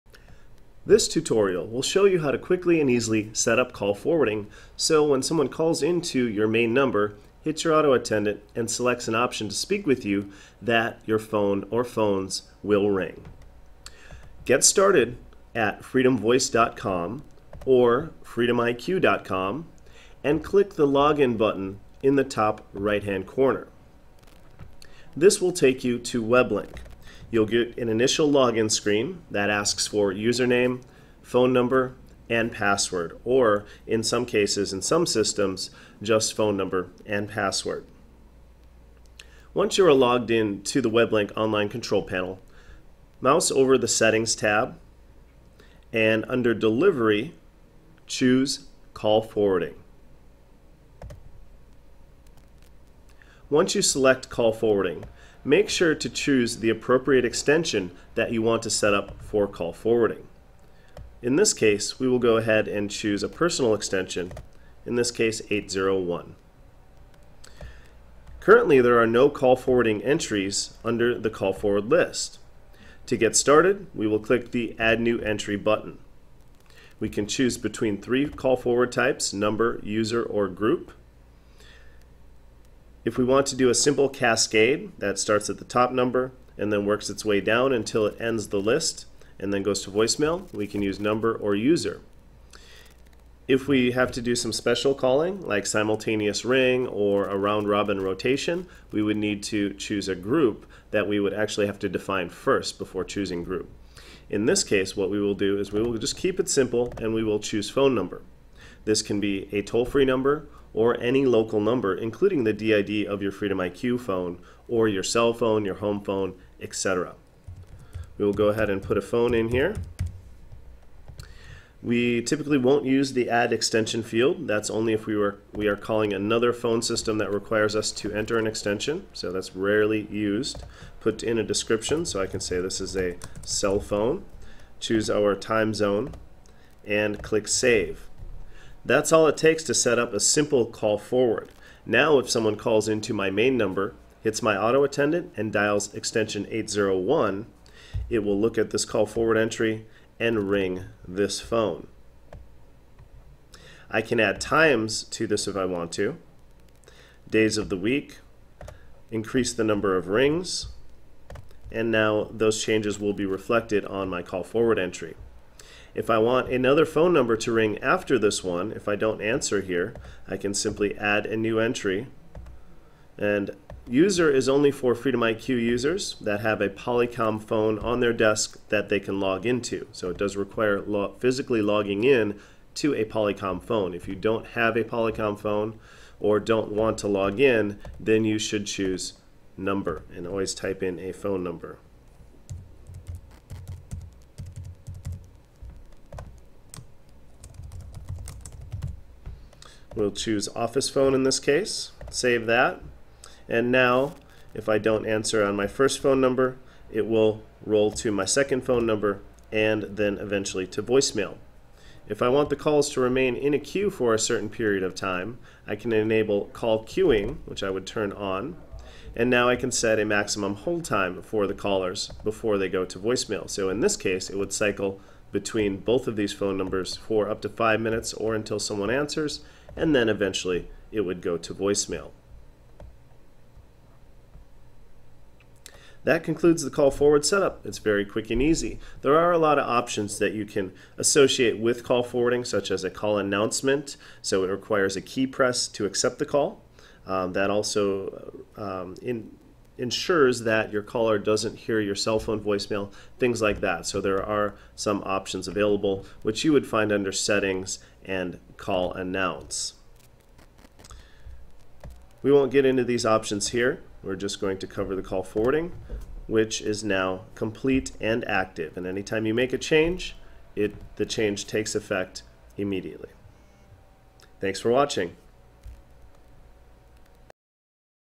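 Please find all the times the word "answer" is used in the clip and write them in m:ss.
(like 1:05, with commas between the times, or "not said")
2:49, 3:25, 3:48.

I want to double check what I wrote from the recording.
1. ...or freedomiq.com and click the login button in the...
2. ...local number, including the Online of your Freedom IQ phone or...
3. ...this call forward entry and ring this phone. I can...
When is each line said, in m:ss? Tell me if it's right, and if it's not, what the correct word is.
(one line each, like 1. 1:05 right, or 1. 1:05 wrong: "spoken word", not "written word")
1. 0:17 right
2. 1:51 wrong: "DID", not "Online"
3. 2:28 right.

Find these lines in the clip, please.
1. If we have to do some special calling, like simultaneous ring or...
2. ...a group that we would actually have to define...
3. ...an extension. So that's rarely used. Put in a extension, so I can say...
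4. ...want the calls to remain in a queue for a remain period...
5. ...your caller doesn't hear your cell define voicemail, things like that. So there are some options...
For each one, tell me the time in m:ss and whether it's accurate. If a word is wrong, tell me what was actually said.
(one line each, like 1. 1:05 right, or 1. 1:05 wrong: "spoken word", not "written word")
1. 1:33 right
2. 1:40 right
3. 2:08 wrong: "description", not "extension"
4. 3:32 wrong: "certain", not "remain"
5. 4:10 wrong: "phone", not "define".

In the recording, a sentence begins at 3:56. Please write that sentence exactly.
That concludes the call forward setup.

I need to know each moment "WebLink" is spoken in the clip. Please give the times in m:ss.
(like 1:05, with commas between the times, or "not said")
0:26, 0:40.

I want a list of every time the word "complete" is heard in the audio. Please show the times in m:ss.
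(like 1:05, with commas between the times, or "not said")
4:27.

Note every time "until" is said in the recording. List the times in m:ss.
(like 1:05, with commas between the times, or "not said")
1:27, 3:48.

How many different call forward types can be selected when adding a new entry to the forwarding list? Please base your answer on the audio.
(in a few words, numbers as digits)
3.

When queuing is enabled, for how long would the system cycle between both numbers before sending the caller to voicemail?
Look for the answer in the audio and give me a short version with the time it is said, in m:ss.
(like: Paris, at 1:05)
5 minutes, at 3:47.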